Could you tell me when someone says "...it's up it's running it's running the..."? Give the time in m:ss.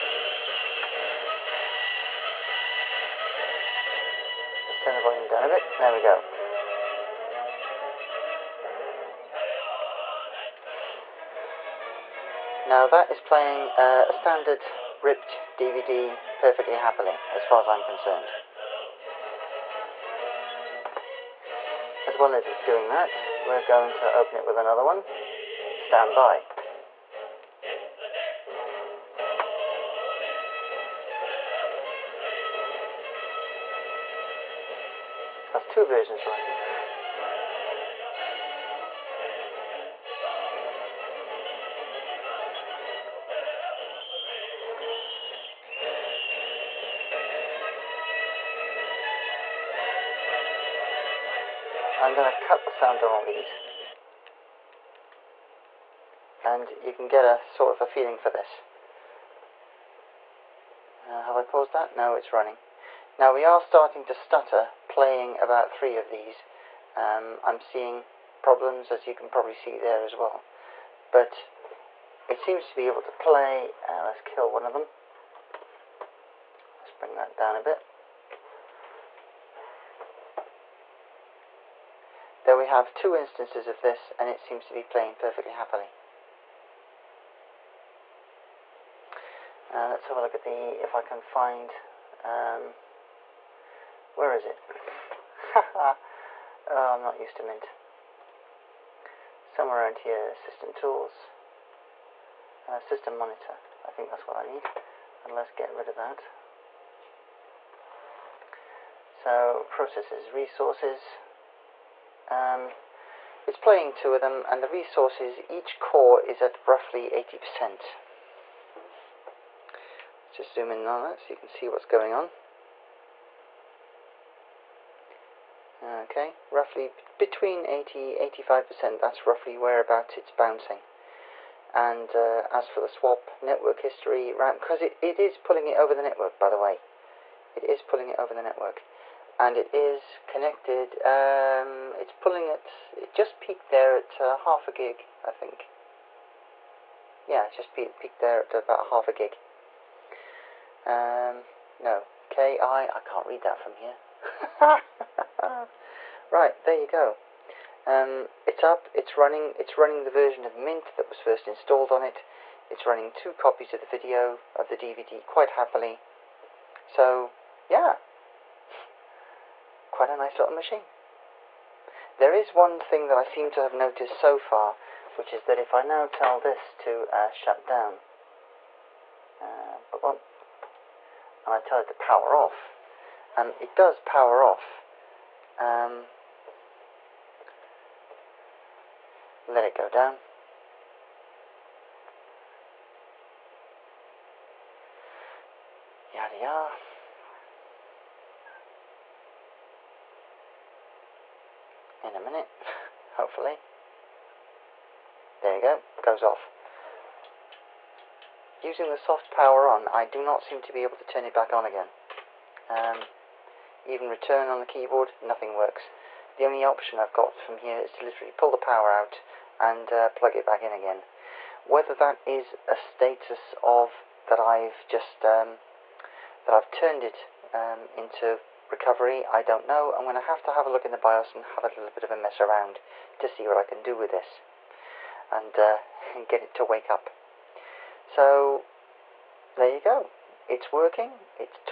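2:38.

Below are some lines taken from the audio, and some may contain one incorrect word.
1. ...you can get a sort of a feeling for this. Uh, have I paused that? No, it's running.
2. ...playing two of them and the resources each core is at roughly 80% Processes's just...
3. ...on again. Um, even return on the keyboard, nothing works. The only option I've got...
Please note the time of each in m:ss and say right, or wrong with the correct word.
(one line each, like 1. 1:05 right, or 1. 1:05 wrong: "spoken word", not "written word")
1. 0:56 right
2. 1:53 wrong: "Let", not "Processes"
3. 3:31 right.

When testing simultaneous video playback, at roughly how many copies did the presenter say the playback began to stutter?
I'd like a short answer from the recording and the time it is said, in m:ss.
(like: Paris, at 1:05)
3, at 1:05.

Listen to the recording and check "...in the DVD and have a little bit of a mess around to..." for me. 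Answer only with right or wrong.
wrong.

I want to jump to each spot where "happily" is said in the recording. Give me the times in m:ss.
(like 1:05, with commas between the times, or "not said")
0:16, 1:25, 2:45.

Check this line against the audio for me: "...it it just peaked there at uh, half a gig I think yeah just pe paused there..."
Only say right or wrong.
wrong.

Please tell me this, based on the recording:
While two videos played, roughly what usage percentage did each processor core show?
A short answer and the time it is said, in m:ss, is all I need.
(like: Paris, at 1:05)
80 to 85%, at 2:07.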